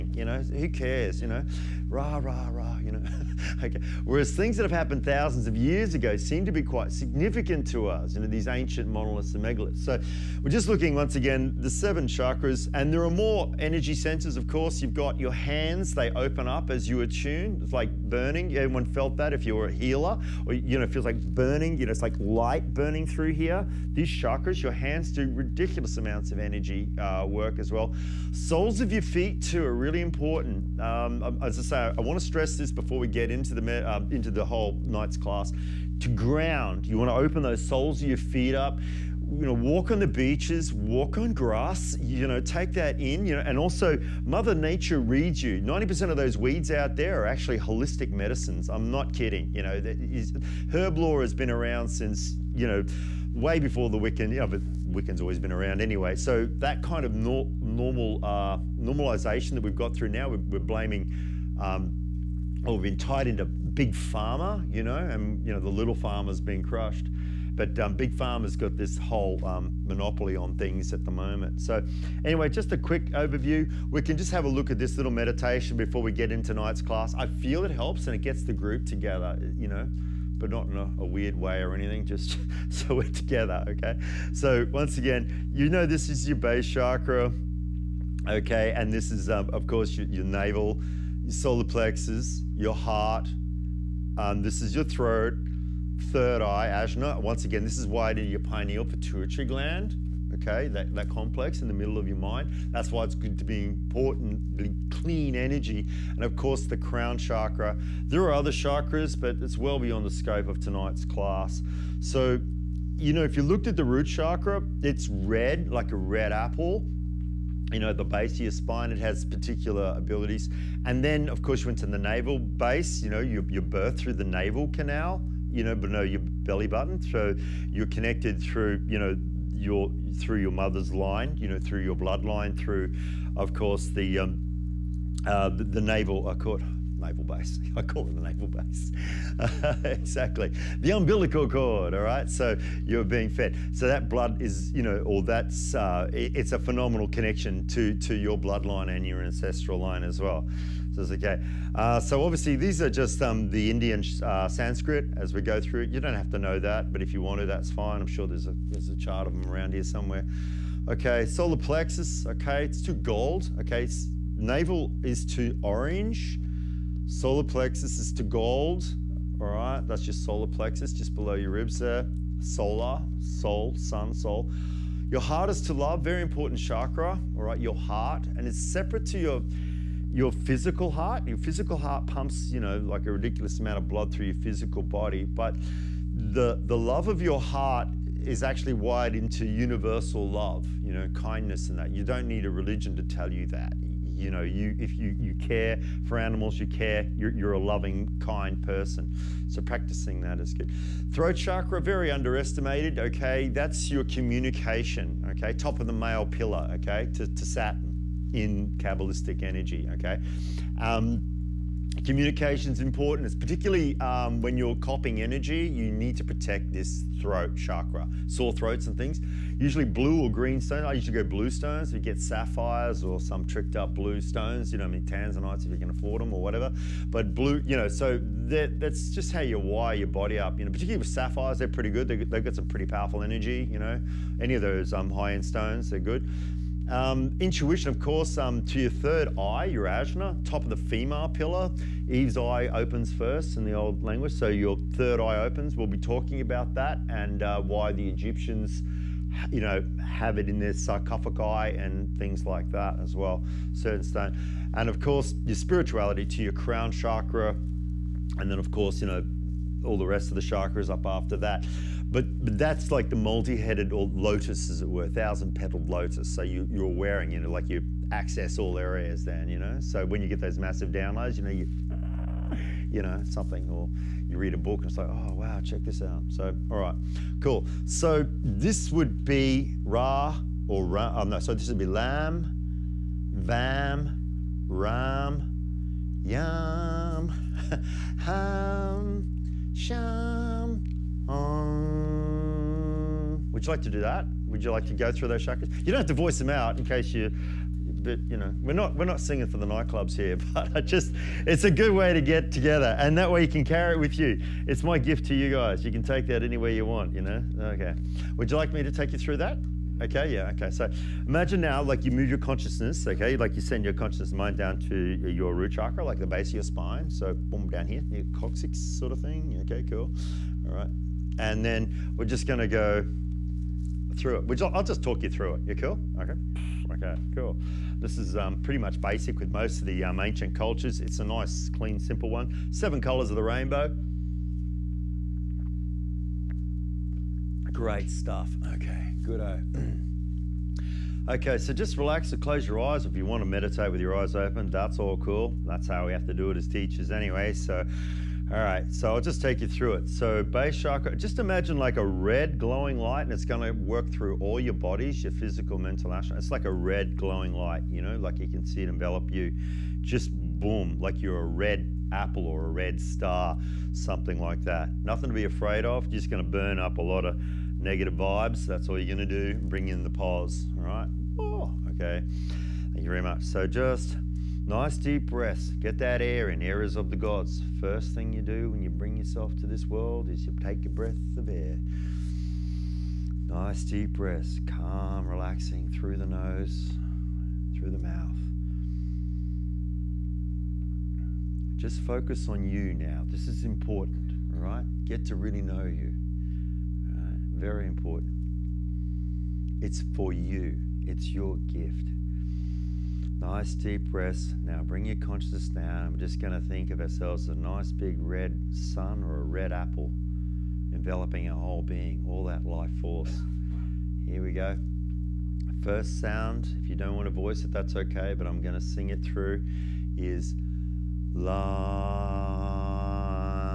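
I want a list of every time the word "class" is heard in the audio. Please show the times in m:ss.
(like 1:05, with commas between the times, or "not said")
0:35, 1:16, 1:51.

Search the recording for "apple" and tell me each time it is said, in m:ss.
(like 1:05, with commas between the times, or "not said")
1:56, 6:02, 6:49.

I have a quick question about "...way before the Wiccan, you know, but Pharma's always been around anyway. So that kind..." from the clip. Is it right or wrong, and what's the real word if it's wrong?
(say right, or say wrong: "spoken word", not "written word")
wrong: "Wiccan", not "Pharma".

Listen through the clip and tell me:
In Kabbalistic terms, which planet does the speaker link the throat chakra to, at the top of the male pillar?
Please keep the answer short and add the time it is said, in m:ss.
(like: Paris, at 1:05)
Saturn, at 3:27.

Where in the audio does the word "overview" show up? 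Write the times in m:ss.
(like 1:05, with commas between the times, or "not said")
1:13.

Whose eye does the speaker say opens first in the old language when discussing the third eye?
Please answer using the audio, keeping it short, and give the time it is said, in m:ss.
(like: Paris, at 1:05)
Eve's, at 4:02.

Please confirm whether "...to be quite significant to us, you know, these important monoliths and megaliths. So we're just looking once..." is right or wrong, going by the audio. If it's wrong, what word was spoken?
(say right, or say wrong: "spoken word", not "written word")
wrong: "ancient", not "important".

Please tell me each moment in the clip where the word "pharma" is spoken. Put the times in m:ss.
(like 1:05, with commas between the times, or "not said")
1:03, 1:08.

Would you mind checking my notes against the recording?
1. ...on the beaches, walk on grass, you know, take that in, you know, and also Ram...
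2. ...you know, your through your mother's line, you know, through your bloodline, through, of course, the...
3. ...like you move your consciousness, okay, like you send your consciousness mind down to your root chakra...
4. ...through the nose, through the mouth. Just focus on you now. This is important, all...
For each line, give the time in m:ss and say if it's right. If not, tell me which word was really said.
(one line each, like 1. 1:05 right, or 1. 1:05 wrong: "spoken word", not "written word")
1. 0:39 wrong: "Mother", not "Ram"
2. 2:08 right
3. 5:11 right
4. 6:25 right.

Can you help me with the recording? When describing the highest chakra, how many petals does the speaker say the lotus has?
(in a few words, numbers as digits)
1000.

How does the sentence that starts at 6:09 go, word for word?
Bring in the pause, all right?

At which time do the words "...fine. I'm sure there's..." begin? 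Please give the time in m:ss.
2:37.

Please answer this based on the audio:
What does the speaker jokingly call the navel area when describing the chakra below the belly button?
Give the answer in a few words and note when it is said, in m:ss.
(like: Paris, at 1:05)
the naval base, at 2:18.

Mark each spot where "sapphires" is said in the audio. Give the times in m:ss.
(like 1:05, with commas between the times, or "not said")
3:42, 3:51.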